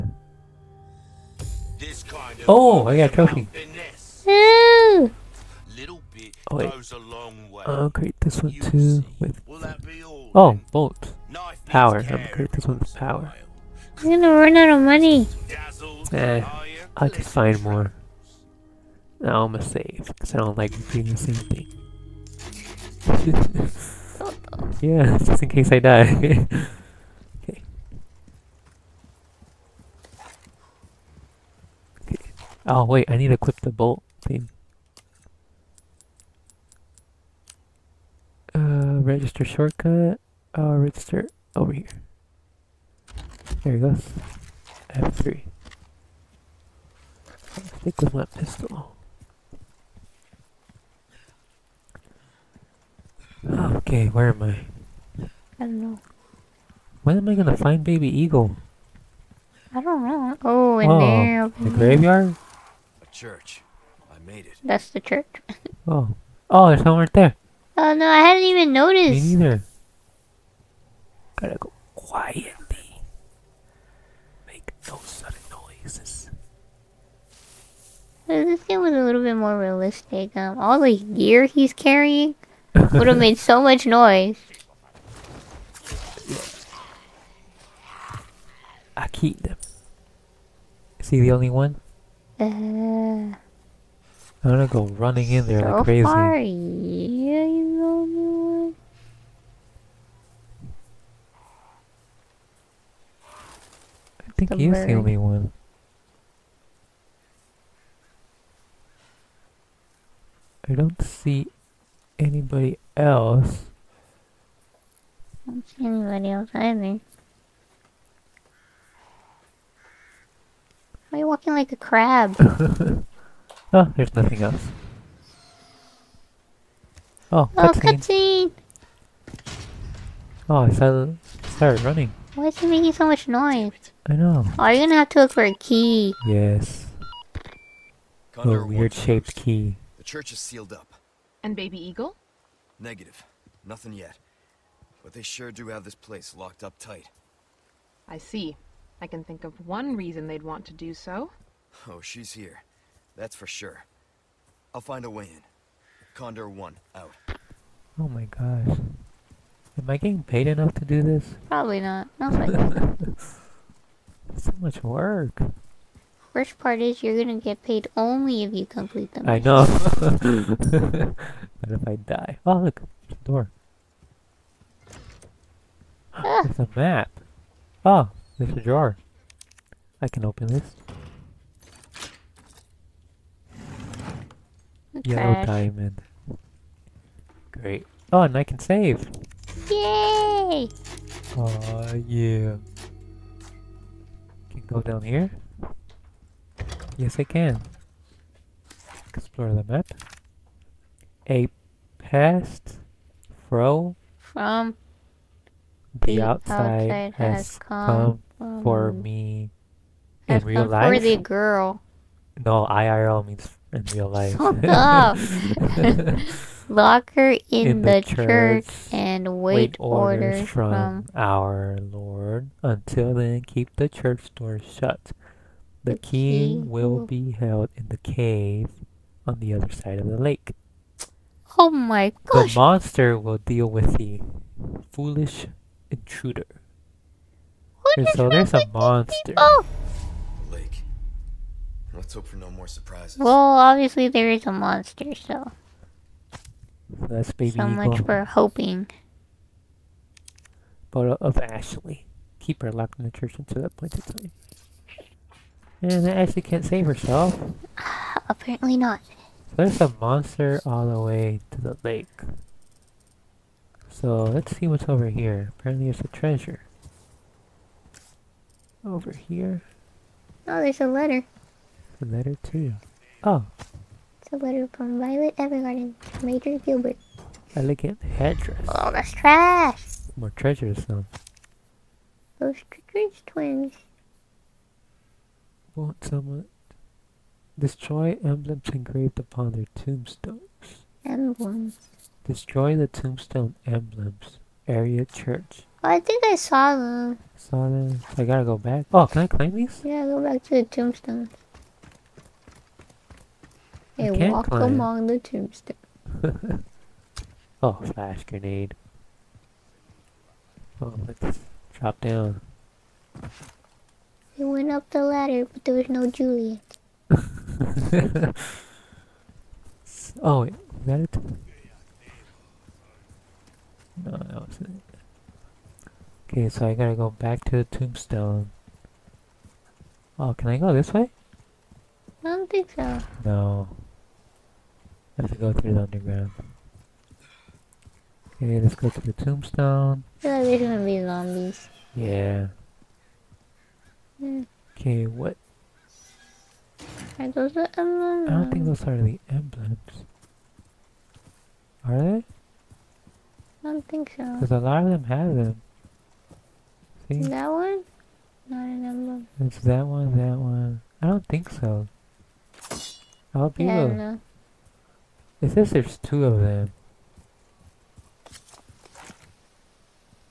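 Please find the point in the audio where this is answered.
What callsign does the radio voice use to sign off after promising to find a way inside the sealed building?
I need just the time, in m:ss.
2:36.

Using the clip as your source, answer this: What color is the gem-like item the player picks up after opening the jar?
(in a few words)
Yellow.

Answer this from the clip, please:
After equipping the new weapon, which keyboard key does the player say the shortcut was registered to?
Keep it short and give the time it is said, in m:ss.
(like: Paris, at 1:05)
F3, at 0:44.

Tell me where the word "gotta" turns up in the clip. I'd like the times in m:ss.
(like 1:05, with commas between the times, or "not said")
1:11, 4:58, 5:26.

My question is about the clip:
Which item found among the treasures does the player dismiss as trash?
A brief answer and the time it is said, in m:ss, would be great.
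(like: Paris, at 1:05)
Elegant headdress, at 4:37.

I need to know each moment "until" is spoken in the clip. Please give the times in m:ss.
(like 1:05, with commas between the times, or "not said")
3:42, 4:13.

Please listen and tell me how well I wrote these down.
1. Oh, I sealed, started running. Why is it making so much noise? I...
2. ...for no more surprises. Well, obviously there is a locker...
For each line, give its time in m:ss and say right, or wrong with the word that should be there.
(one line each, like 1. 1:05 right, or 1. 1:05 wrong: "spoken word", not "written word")
1. 2:10 wrong: "started", not "sealed"
2. 4:02 wrong: "monster", not "locker".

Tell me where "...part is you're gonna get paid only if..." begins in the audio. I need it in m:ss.
2:46.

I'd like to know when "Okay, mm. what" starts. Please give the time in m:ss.
5:44.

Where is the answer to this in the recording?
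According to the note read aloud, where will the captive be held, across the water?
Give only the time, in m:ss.
3:47.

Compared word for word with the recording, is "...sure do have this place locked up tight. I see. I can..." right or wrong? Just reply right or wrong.
right.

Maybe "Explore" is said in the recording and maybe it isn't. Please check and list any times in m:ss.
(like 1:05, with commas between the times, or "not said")
3:19.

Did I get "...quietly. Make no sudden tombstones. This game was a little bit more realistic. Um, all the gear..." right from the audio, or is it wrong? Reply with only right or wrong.
wrong.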